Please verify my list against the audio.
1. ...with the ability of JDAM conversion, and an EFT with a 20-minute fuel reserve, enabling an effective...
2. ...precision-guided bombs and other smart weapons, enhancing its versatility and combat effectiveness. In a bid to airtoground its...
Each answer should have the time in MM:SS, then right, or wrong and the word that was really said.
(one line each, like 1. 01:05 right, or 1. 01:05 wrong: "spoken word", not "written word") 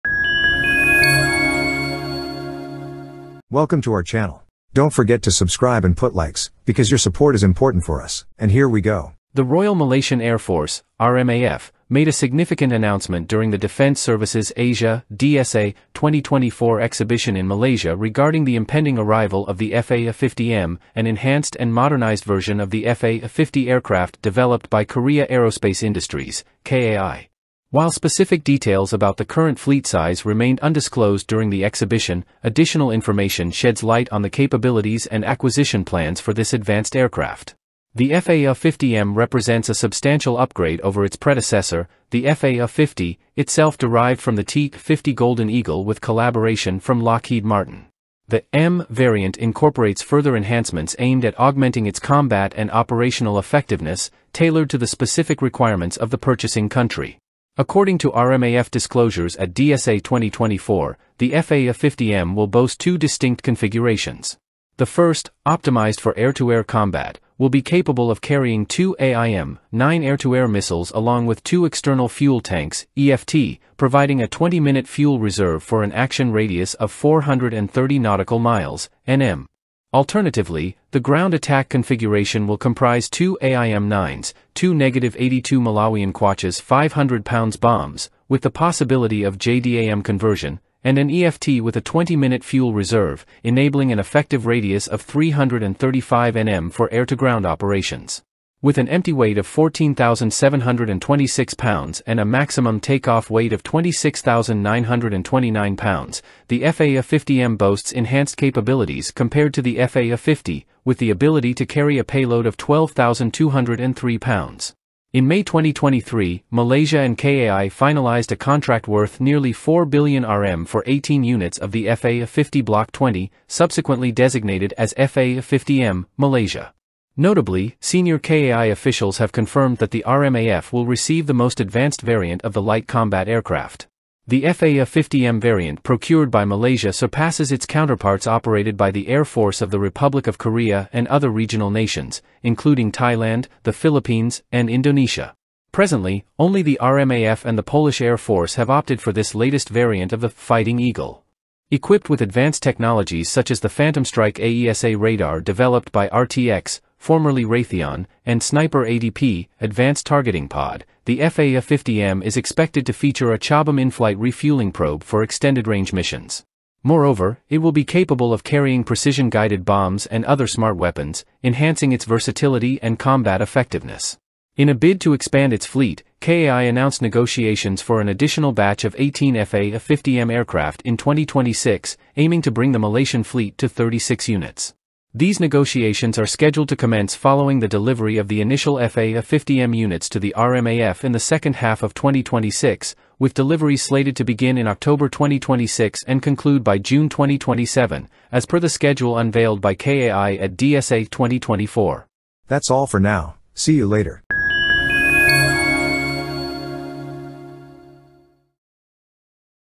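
1. 01:28 wrong: "possibility", not "ability"
2. 02:48 wrong: "expand", not "airtoground".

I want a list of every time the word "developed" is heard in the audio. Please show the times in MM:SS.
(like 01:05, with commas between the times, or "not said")
00:24, 02:35.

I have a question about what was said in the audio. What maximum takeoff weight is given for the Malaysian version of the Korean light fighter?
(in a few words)
26,929 pounds.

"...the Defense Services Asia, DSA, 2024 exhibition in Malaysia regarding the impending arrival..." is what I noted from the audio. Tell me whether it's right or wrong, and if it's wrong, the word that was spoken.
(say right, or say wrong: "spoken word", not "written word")
right.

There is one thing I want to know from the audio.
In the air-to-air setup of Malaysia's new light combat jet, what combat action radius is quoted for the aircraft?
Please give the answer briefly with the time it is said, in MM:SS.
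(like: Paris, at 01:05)
430 nautical miles, at 01:16.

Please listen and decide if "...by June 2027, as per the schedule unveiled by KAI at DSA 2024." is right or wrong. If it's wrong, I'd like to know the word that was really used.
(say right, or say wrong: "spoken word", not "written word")
right.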